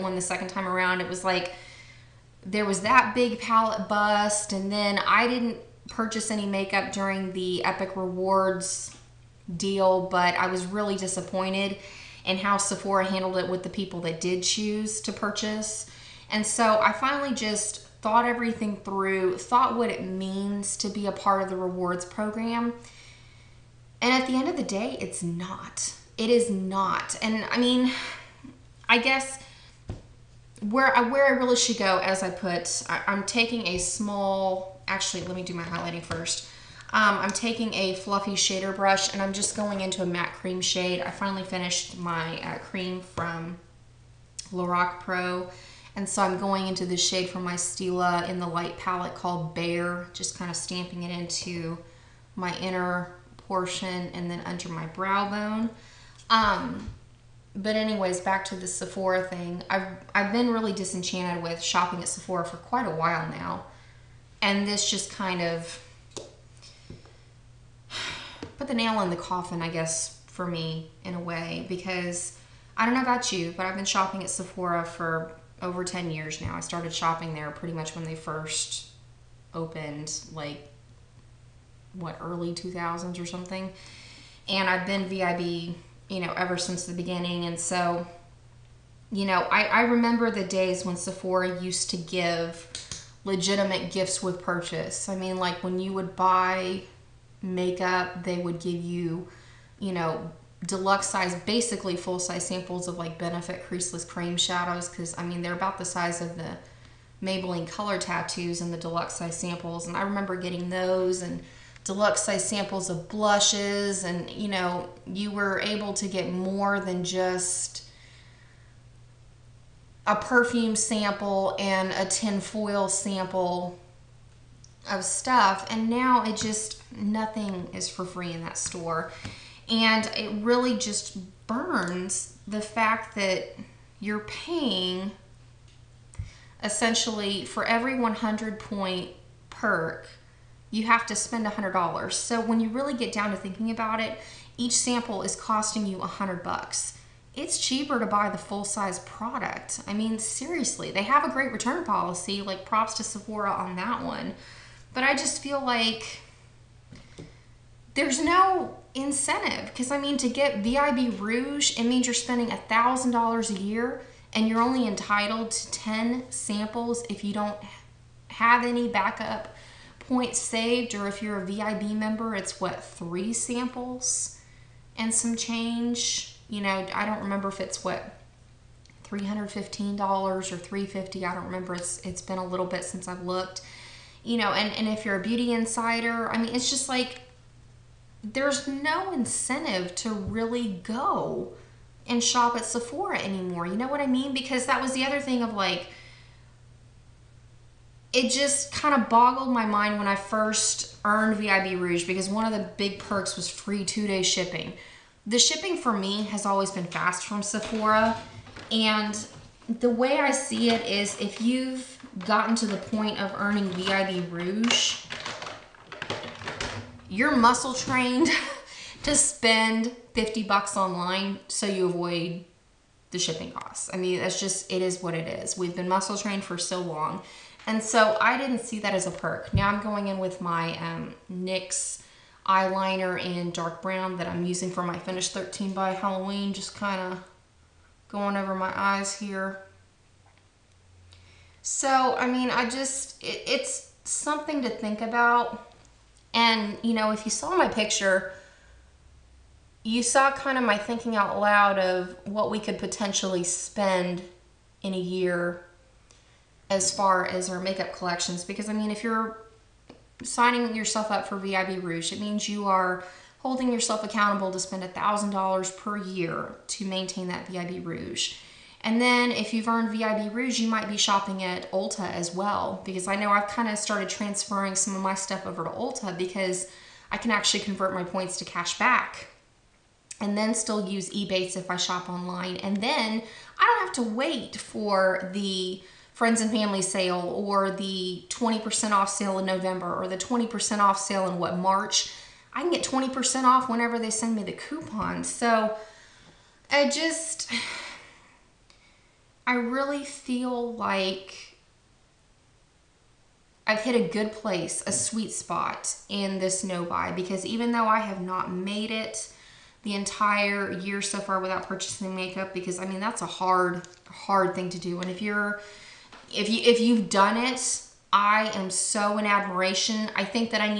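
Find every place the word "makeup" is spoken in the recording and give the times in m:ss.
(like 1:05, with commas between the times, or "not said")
0:06, 1:37, 4:17, 5:12.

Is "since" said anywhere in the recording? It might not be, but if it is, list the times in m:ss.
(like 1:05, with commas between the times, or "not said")
1:26, 3:02.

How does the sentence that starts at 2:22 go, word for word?
So when you really get down to thinking about it, each sample is costing you 100 bucks.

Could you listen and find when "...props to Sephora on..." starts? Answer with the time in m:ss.
2:32.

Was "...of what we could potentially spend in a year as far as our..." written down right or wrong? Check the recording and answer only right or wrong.
right.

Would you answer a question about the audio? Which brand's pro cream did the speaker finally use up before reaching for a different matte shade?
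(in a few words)
Lorac.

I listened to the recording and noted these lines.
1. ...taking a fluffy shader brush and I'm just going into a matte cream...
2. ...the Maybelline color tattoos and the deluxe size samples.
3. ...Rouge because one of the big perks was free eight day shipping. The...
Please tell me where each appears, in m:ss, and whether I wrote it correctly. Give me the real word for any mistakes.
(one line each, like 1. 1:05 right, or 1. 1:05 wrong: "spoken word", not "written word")
1. 0:37 right
2. 1:46 right
3. 3:21 wrong: "two", not "eight".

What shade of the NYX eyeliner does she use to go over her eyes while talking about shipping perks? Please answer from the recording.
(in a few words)
dark brown.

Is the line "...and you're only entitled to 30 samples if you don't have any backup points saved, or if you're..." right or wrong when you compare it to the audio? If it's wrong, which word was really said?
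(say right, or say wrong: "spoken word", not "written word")
wrong: "10", not "30".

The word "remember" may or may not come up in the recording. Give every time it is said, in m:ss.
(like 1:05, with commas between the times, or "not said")
1:29, 1:50, 2:57, 3:01.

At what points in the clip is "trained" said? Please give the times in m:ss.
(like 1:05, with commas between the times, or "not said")
3:37, 3:46.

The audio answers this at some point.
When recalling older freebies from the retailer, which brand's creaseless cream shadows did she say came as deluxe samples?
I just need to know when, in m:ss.
1:43.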